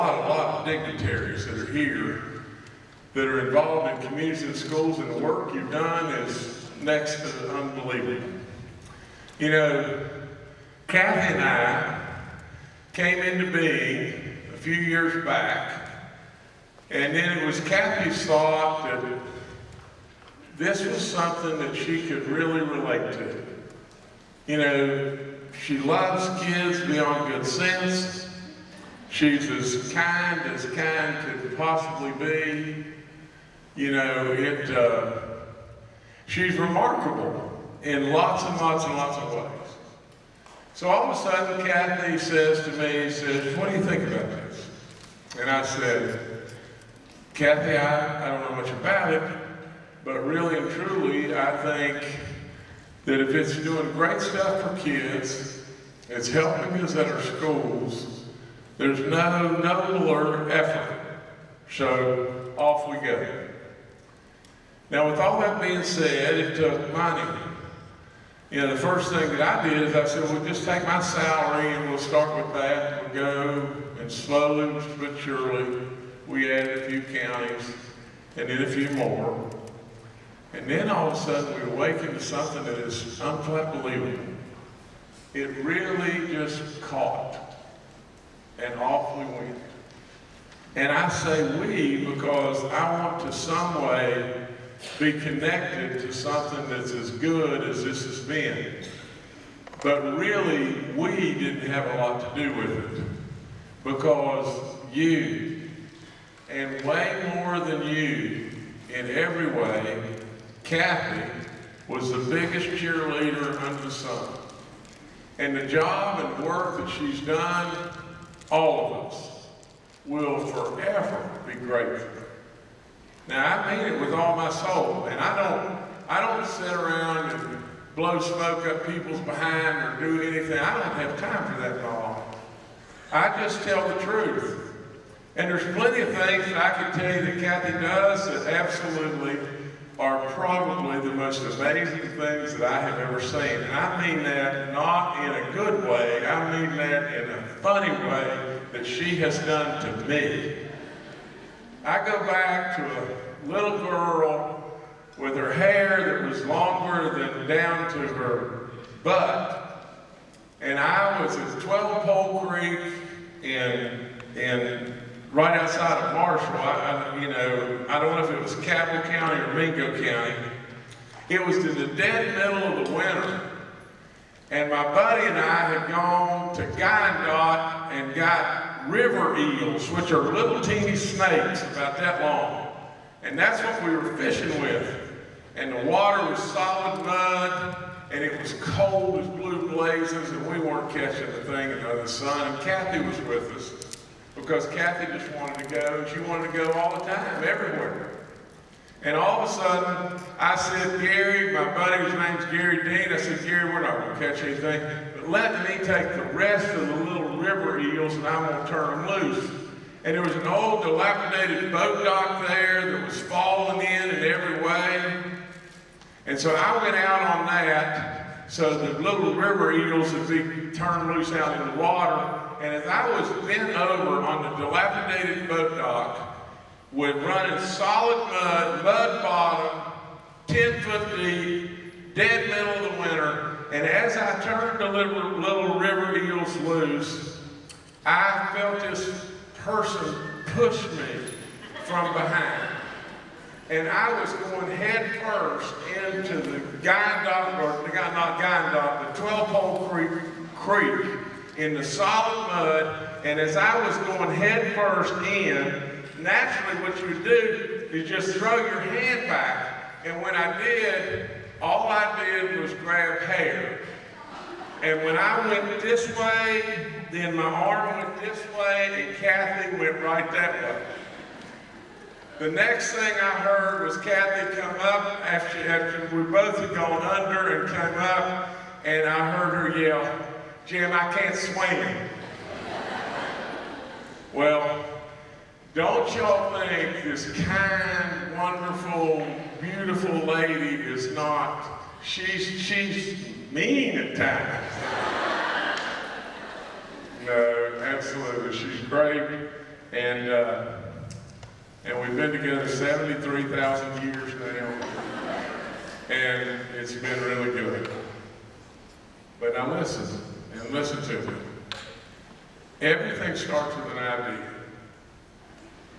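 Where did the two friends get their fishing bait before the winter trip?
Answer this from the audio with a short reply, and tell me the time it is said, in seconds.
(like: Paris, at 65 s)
Guyandotte, at 176 s.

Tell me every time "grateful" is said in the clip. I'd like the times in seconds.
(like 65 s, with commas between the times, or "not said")
121 s.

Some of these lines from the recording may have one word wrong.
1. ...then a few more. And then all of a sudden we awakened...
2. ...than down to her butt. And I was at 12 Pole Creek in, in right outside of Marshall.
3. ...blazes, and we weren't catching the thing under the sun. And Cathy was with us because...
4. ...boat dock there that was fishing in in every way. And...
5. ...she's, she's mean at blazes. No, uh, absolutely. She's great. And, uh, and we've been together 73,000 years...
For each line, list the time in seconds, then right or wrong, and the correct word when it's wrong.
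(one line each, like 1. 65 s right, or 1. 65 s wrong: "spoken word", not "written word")
1. 78 s right
2. 157 s right
3. 189 s right
4. 211 s wrong: "falling", not "fishing"
5. 292 s wrong: "times", not "blazes".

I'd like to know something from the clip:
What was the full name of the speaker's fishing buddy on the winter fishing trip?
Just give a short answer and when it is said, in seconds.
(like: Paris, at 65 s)
Gary Dean, at 202 s.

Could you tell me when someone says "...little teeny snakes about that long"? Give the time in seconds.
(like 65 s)
180 s.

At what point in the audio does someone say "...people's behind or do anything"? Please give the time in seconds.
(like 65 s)
128 s.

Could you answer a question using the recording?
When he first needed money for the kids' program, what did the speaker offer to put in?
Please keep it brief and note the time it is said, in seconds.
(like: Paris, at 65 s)
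My salary, at 70 s.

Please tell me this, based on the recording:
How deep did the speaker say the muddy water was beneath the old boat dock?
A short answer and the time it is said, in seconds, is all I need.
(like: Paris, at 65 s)
10 feet, at 230 s.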